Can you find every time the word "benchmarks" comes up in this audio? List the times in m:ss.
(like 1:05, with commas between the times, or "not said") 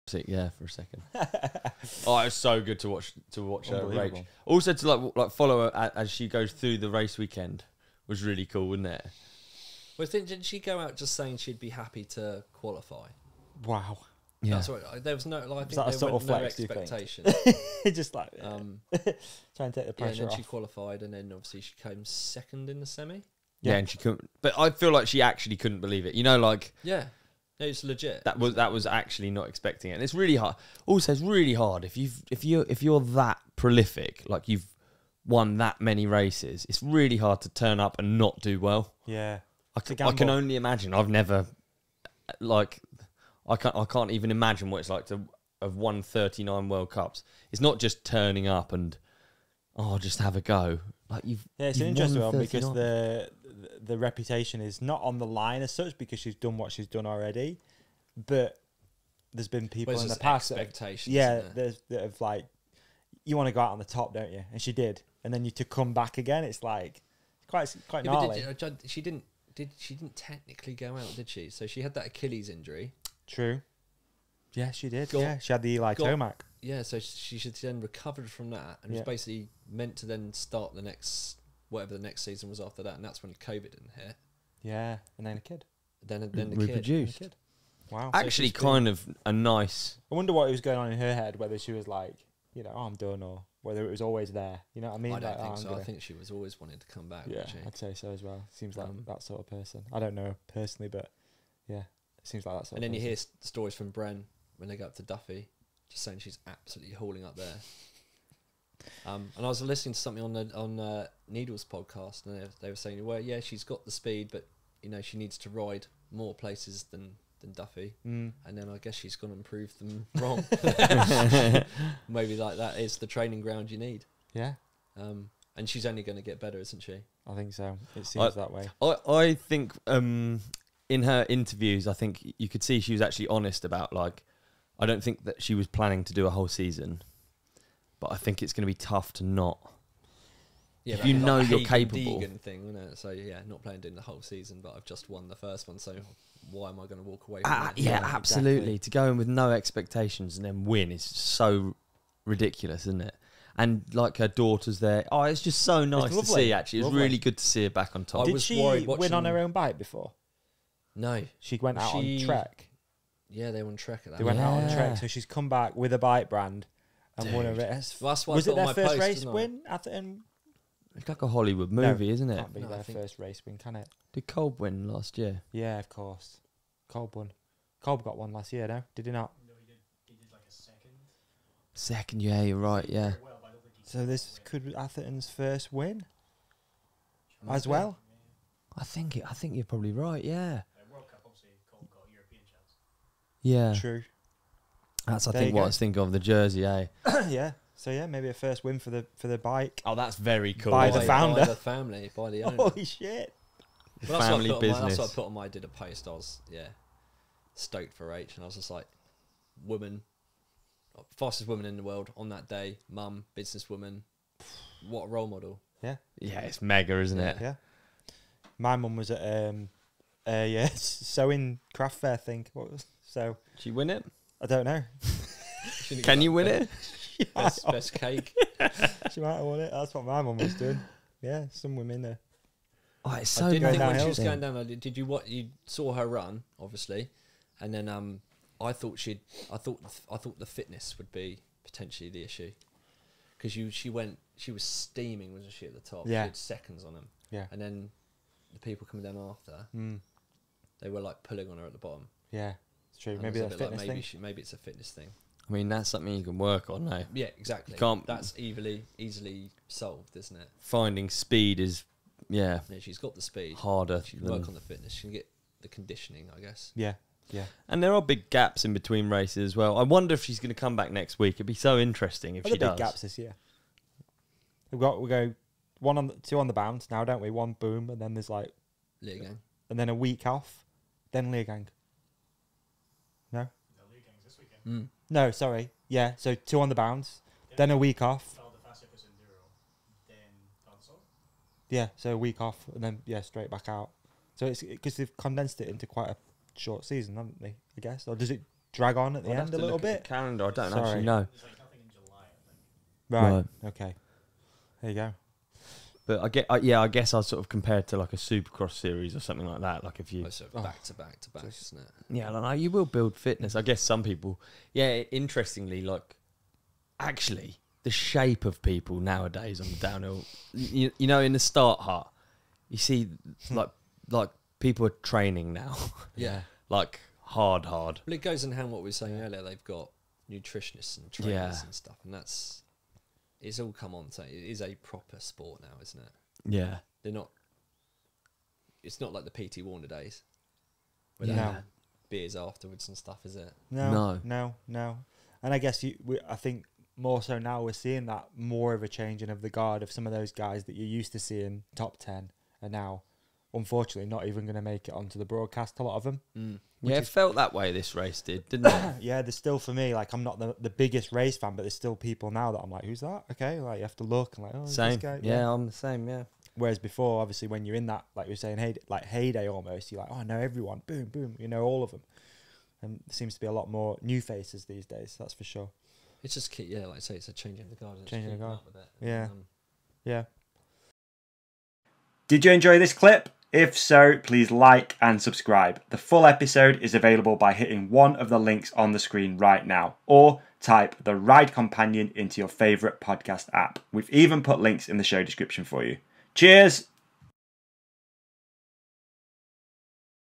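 not said.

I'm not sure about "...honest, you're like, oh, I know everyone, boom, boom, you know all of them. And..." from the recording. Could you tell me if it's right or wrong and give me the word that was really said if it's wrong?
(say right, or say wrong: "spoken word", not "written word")
wrong: "almost", not "honest".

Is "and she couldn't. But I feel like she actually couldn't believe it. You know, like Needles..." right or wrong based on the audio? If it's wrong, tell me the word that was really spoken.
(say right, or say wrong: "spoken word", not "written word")
wrong: "Yeah", not "Needles".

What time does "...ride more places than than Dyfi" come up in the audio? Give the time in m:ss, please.
1:55.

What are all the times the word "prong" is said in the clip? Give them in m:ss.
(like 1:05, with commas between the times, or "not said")
not said.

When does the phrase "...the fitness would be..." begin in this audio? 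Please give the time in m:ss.
4:00.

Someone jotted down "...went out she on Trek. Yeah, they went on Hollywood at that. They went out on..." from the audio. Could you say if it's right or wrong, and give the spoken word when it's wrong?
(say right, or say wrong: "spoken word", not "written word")
wrong: "Trek", not "Hollywood".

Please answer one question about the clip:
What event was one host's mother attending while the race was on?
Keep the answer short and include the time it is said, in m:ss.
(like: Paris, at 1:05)
sewing craft fair, at 3:40.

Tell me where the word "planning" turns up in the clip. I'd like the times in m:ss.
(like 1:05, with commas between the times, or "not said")
2:15.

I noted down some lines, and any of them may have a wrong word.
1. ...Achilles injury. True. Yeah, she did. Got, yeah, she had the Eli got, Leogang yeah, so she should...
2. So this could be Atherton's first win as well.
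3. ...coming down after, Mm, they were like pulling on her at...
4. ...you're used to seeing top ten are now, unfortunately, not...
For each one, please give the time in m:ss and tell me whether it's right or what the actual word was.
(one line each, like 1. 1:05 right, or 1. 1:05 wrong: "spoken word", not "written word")
1. 1:12 wrong: "Tomac", not "Leogang"
2. 3:03 right
3. 4:08 right
4. 5:50 right.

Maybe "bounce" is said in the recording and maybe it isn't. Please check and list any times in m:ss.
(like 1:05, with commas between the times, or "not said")
4:36, 4:46.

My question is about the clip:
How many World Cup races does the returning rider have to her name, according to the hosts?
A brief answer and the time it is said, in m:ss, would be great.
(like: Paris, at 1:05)
39, at 0:46.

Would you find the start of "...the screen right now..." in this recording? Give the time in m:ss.
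6:28.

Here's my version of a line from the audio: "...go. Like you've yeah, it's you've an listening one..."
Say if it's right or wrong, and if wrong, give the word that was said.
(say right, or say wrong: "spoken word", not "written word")
wrong: "interesting", not "listening".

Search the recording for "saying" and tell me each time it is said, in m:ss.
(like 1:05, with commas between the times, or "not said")
0:11, 1:46, 1:52, 5:28, 6:08.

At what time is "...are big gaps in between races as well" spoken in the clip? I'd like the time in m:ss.
4:27.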